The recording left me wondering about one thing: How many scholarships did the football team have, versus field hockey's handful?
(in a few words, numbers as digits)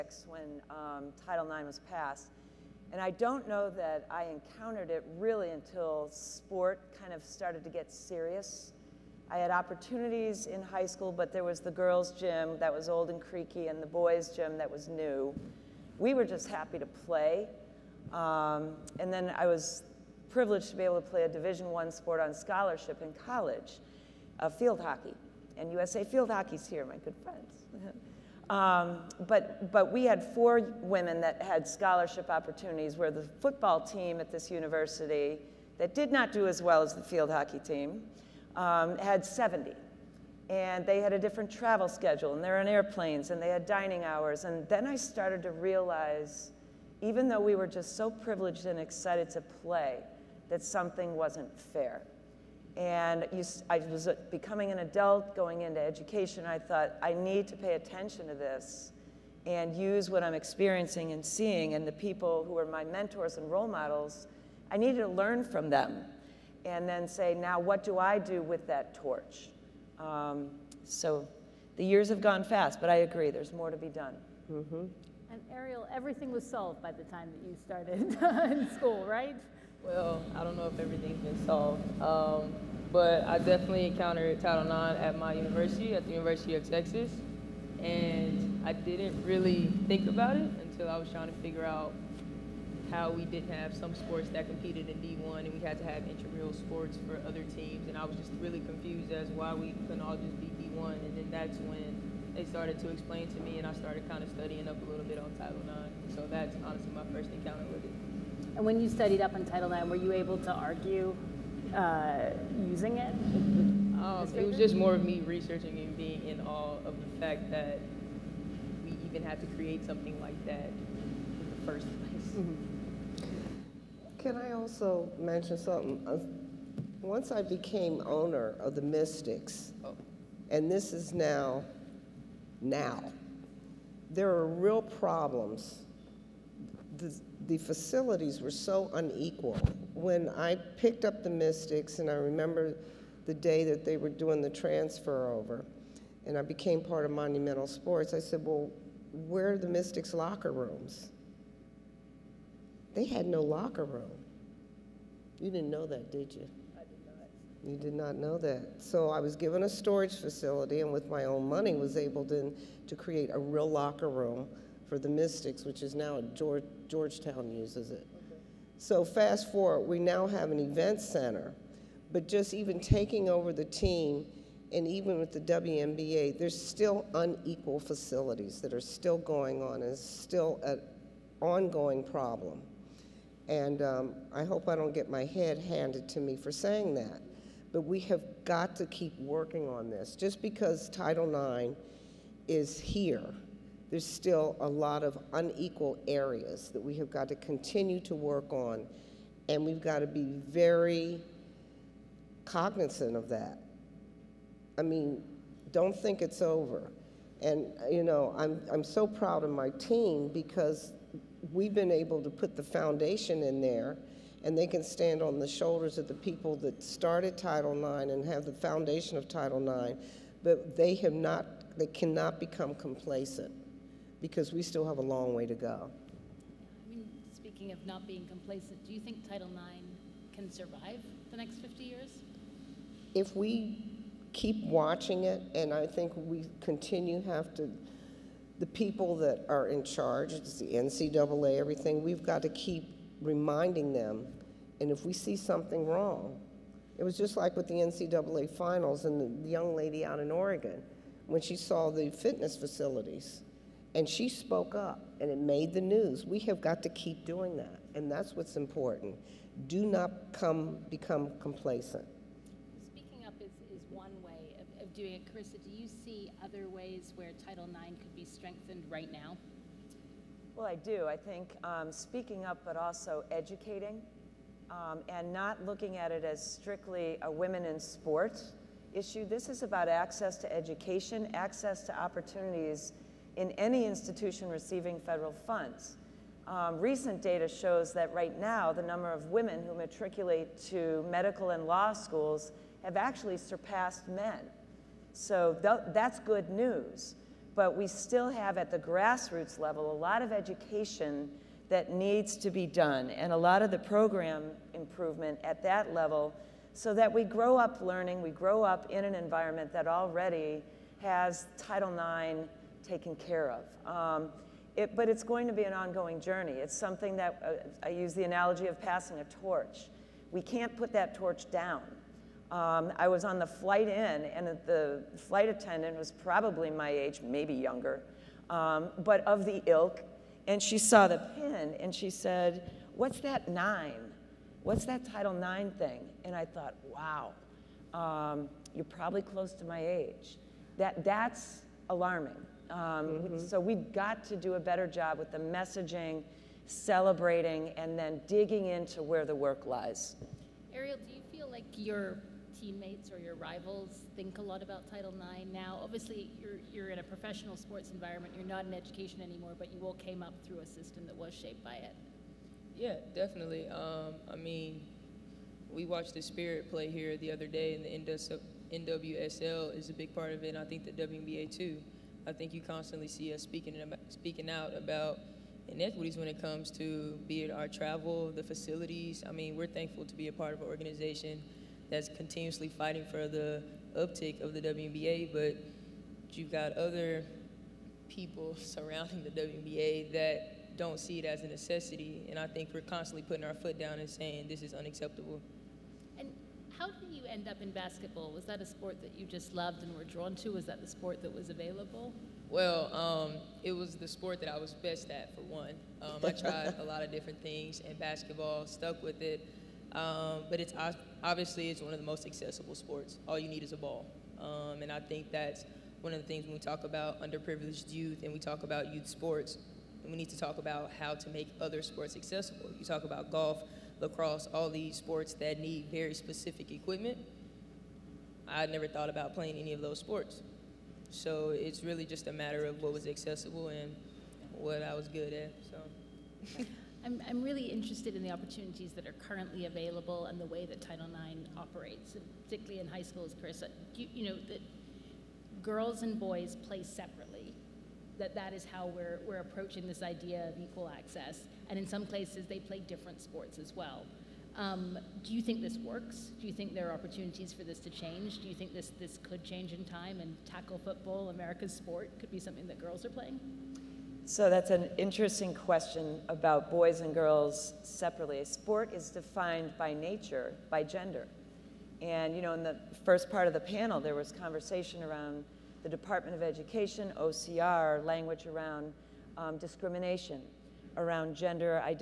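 70.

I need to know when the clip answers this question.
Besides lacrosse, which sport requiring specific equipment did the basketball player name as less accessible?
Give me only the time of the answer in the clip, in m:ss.
7:03.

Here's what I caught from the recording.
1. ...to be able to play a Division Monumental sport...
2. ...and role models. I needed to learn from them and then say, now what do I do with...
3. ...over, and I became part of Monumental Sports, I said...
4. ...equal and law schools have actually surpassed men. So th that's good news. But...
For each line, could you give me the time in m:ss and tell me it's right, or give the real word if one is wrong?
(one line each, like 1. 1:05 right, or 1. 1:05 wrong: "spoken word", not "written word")
1. 0:20 wrong: "One", not "Monumental"
2. 1:03 right
3. 2:25 right
4. 4:51 wrong: "medical", not "equal".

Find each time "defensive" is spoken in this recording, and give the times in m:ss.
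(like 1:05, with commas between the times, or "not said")
not said.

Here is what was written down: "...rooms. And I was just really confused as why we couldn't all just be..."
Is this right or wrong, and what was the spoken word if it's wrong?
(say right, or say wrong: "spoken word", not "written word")
wrong: "teams", not "rooms".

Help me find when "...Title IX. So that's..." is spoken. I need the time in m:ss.
1:45.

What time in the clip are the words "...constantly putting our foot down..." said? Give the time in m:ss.
6:32.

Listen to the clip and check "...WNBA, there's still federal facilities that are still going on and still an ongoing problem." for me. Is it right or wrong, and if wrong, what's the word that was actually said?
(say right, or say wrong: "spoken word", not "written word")
wrong: "unequal", not "federal".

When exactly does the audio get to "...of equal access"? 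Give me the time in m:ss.
7:30.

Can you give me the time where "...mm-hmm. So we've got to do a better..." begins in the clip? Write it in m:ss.
5:42.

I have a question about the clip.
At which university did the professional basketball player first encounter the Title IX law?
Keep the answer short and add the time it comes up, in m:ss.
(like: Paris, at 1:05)
University of Texas, at 1:26.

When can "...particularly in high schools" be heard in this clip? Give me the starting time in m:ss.
7:22.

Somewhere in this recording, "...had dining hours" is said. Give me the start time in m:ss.
0:43.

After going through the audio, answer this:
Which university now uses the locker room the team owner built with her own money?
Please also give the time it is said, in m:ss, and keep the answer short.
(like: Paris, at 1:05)
Georgetown, at 2:46.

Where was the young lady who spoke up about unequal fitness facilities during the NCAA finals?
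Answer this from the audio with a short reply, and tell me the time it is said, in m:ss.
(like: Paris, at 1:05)
Oregon, at 4:10.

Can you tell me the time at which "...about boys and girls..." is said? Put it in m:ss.
7:46.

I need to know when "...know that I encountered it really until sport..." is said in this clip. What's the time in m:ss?
0:03.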